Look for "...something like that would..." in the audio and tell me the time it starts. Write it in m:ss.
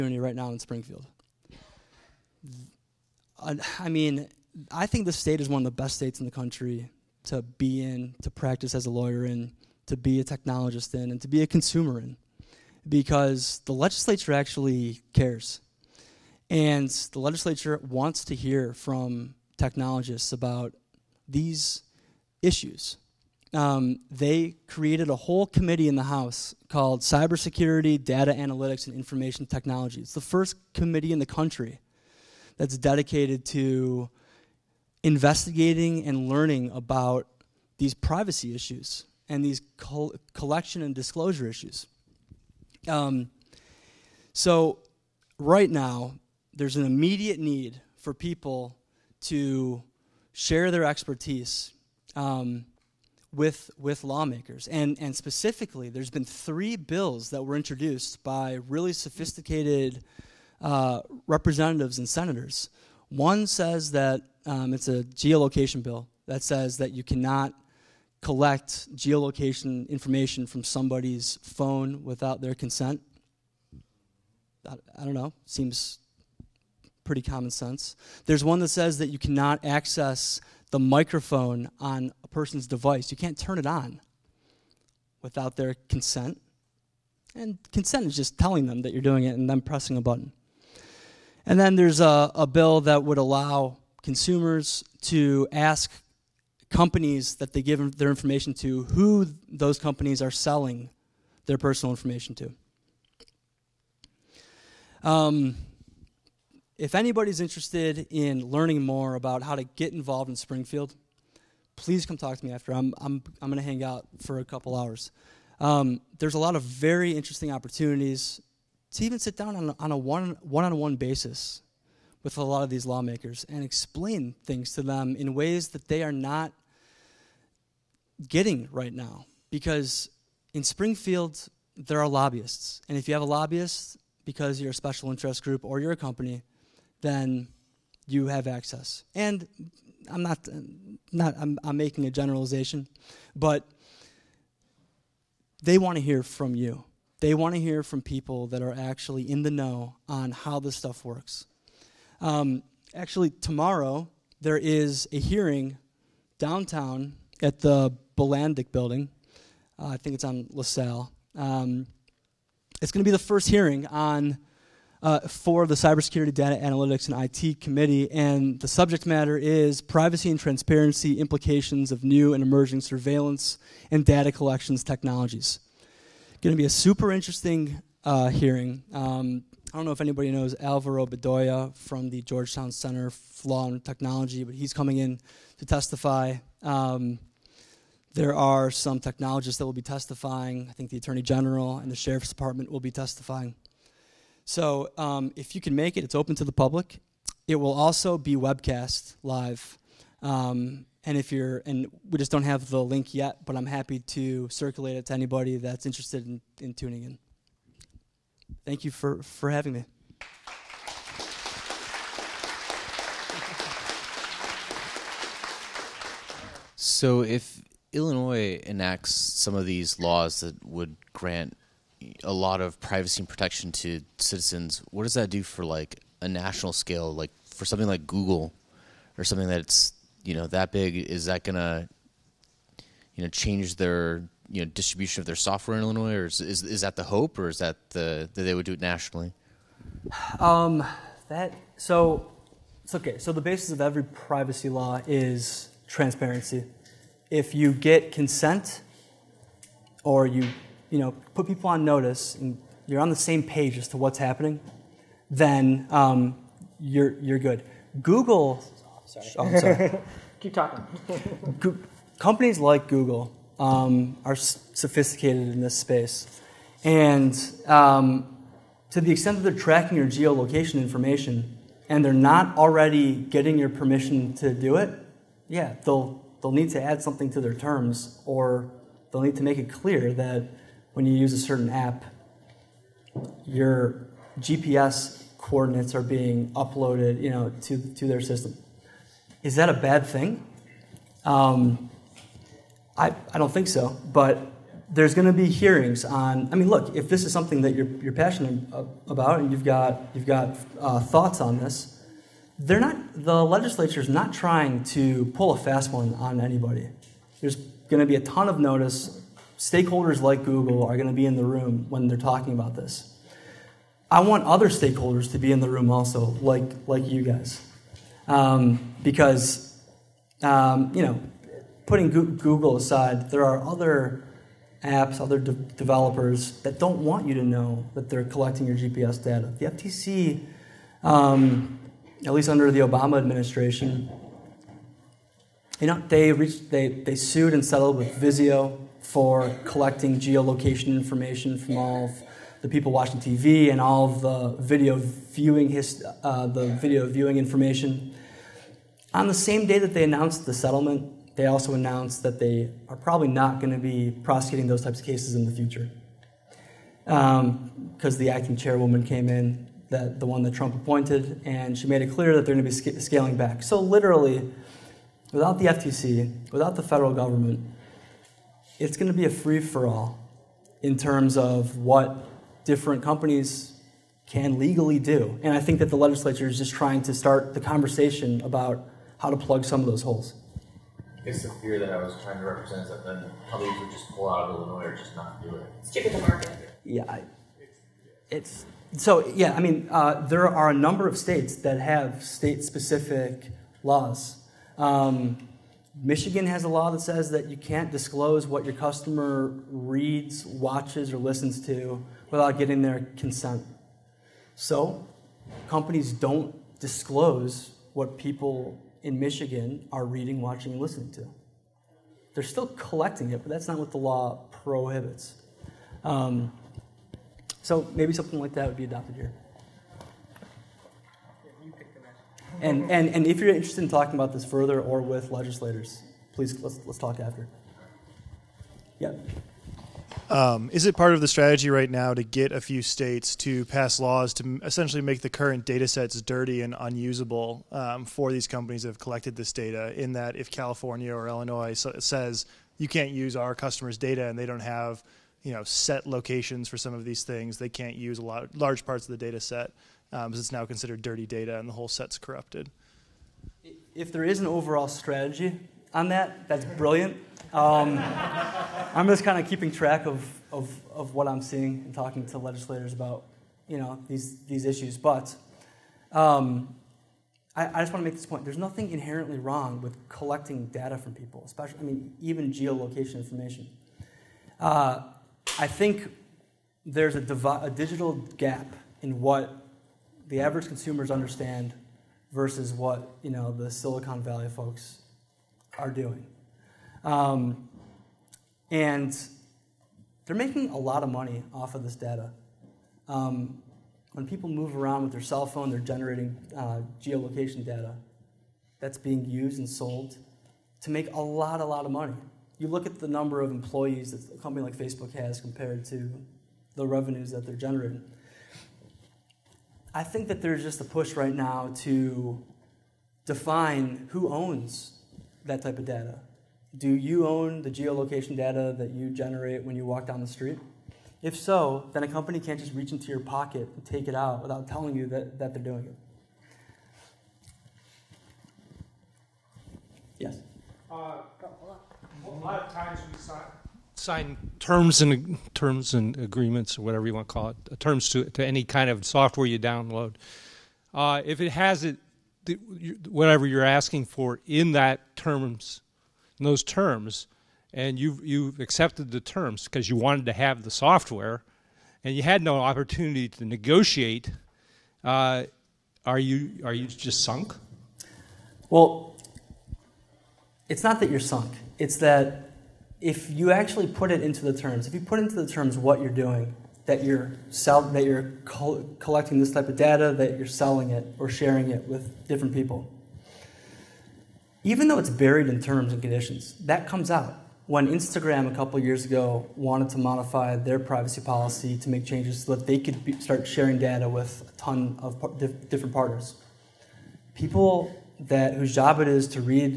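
6:58.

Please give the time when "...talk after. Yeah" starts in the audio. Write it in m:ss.
7:06.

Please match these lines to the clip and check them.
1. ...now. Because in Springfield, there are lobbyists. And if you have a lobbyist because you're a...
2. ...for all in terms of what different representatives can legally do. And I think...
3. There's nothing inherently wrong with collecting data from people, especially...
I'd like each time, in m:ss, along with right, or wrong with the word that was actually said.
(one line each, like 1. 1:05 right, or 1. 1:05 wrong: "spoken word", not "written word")
1. 2:08 right
2. 6:09 wrong: "companies", not "representatives"
3. 7:48 right.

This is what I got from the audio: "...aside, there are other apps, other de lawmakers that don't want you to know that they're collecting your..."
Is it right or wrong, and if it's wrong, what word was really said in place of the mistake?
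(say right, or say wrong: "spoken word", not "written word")
wrong: "developers", not "lawmakers".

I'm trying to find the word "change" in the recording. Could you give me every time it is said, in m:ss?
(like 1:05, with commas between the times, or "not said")
3:53, 9:42.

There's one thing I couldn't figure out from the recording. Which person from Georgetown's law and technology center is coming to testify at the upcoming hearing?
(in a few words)
Alvaro Bedoya.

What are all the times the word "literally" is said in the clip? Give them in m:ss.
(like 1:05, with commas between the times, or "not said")
6:03.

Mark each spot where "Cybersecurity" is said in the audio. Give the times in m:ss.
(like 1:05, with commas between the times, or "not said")
0:27, 2:45.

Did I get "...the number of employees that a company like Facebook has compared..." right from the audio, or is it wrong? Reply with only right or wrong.
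right.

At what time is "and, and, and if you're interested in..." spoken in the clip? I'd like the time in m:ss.
7:02.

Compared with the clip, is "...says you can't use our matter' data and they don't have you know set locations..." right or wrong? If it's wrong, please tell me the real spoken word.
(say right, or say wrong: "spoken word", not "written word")
wrong: "customers", not "matter".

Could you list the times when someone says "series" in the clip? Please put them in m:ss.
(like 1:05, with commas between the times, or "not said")
not said.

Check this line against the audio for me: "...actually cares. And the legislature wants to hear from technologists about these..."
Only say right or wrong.
right.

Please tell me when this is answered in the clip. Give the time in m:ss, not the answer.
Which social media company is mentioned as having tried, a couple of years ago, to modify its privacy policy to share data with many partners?
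9:37.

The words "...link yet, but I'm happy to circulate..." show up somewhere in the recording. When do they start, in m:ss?
3:22.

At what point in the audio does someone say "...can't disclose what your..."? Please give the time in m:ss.
6:37.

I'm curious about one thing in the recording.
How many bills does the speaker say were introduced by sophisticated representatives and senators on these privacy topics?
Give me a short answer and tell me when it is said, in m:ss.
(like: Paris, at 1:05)
3, at 0:56.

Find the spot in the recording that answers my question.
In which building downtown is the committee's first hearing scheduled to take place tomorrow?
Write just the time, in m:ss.
2:38.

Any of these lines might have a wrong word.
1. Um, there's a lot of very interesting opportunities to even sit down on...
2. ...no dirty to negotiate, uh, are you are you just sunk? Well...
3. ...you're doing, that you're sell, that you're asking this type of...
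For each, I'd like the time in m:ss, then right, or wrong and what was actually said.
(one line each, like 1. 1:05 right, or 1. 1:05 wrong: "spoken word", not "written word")
1. 1:55 right
2. 9:12 wrong: "opportunity", not "dirty"
3. 9:26 wrong: "collecting", not "asking".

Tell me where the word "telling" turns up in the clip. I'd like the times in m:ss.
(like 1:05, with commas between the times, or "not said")
1:28, 8:44.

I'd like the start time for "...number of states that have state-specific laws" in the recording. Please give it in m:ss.
6:30.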